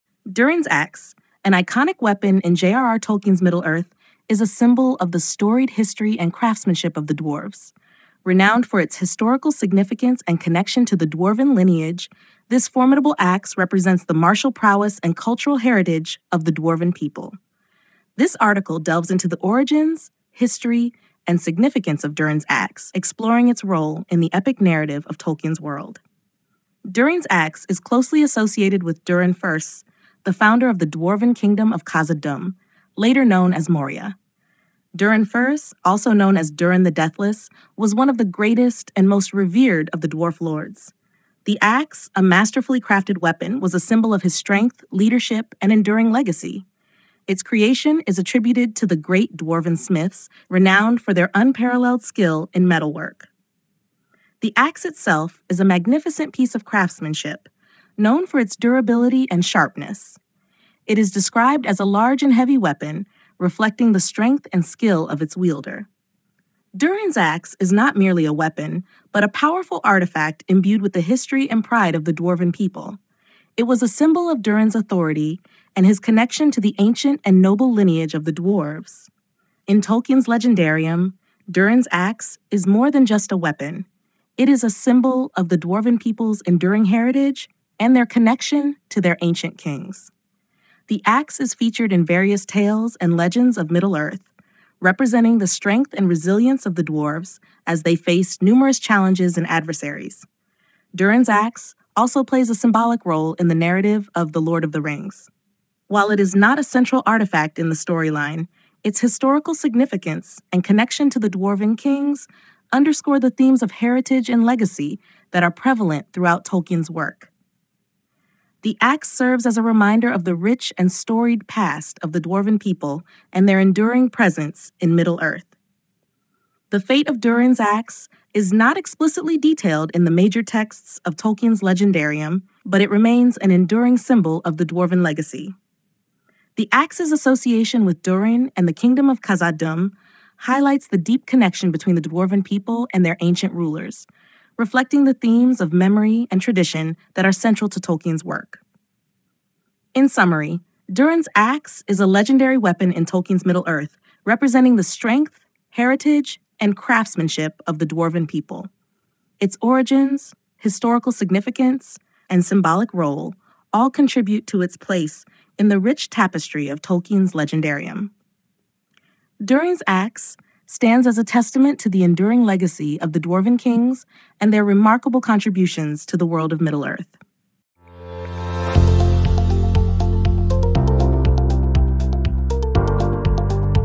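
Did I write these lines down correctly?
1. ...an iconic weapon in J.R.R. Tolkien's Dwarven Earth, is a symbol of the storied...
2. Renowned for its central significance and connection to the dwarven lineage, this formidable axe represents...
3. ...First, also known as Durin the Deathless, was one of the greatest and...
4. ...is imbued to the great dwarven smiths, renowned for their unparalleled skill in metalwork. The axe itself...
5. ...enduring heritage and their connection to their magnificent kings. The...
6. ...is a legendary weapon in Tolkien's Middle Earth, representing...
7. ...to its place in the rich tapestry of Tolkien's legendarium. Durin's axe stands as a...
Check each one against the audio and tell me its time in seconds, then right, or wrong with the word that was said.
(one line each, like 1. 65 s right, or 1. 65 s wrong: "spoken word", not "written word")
1. 1 s wrong: "Middle", not "Dwarven"
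2. 8 s wrong: "historical", not "central"
3. 35 s right
4. 48 s wrong: "attributed", not "imbued"
5. 86 s wrong: "ancient", not "magnificent"
6. 151 s right
7. 164 s right.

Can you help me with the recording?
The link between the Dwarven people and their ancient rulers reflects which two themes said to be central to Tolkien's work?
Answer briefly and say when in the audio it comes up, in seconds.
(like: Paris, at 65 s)
Memory and tradition, at 145 s.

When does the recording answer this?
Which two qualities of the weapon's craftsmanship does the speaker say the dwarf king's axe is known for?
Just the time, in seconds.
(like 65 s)
58 s.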